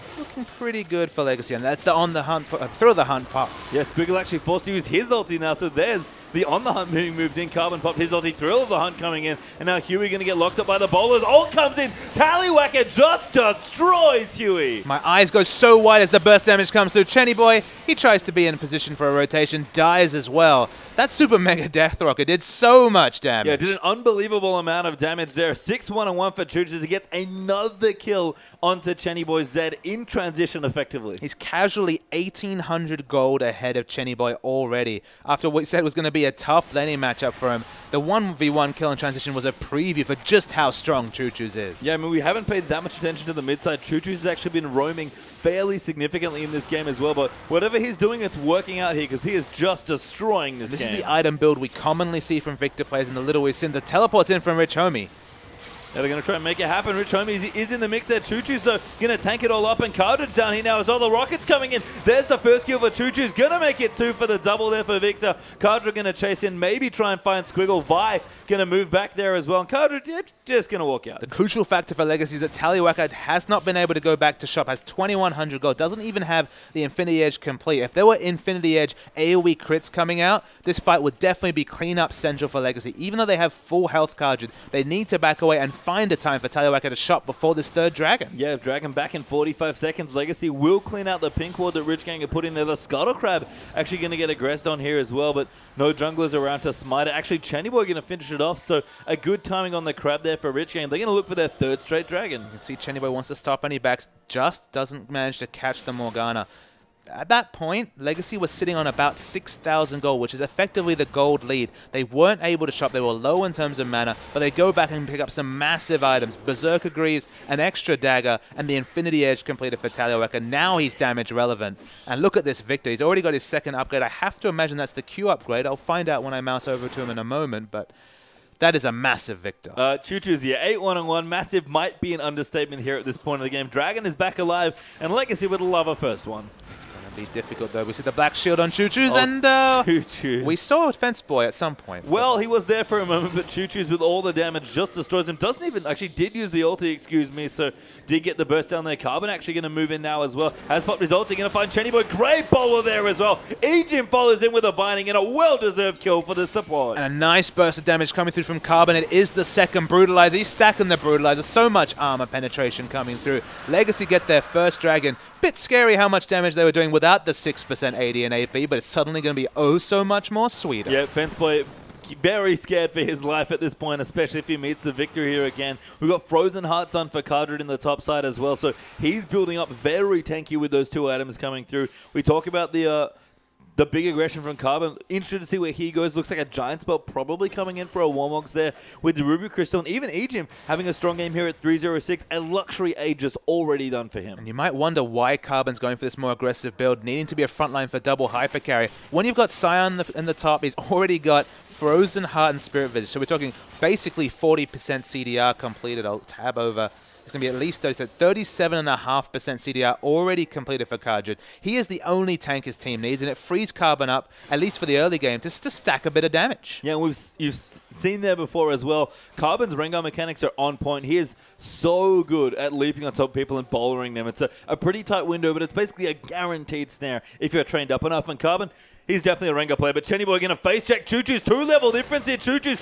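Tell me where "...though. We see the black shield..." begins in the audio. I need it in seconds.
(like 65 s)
137 s.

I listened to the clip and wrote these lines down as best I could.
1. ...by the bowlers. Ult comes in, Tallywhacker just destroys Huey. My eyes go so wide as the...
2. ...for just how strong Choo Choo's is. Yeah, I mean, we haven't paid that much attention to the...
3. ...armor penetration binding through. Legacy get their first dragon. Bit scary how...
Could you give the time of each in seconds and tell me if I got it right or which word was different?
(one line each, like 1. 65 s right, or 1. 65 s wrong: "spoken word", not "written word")
1. 10 s right
2. 40 s right
3. 161 s wrong: "coming", not "binding".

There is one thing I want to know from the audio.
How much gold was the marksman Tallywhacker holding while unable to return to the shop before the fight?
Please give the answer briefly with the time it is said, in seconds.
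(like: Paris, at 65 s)
2,100, at 74 s.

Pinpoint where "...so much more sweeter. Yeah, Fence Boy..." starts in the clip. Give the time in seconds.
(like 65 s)
169 s.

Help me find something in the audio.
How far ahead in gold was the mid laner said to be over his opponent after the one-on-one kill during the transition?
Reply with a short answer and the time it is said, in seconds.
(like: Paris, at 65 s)
1800 gold, at 32 s.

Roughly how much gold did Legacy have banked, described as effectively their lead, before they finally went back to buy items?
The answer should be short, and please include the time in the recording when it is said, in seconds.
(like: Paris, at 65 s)
6,000, at 109 s.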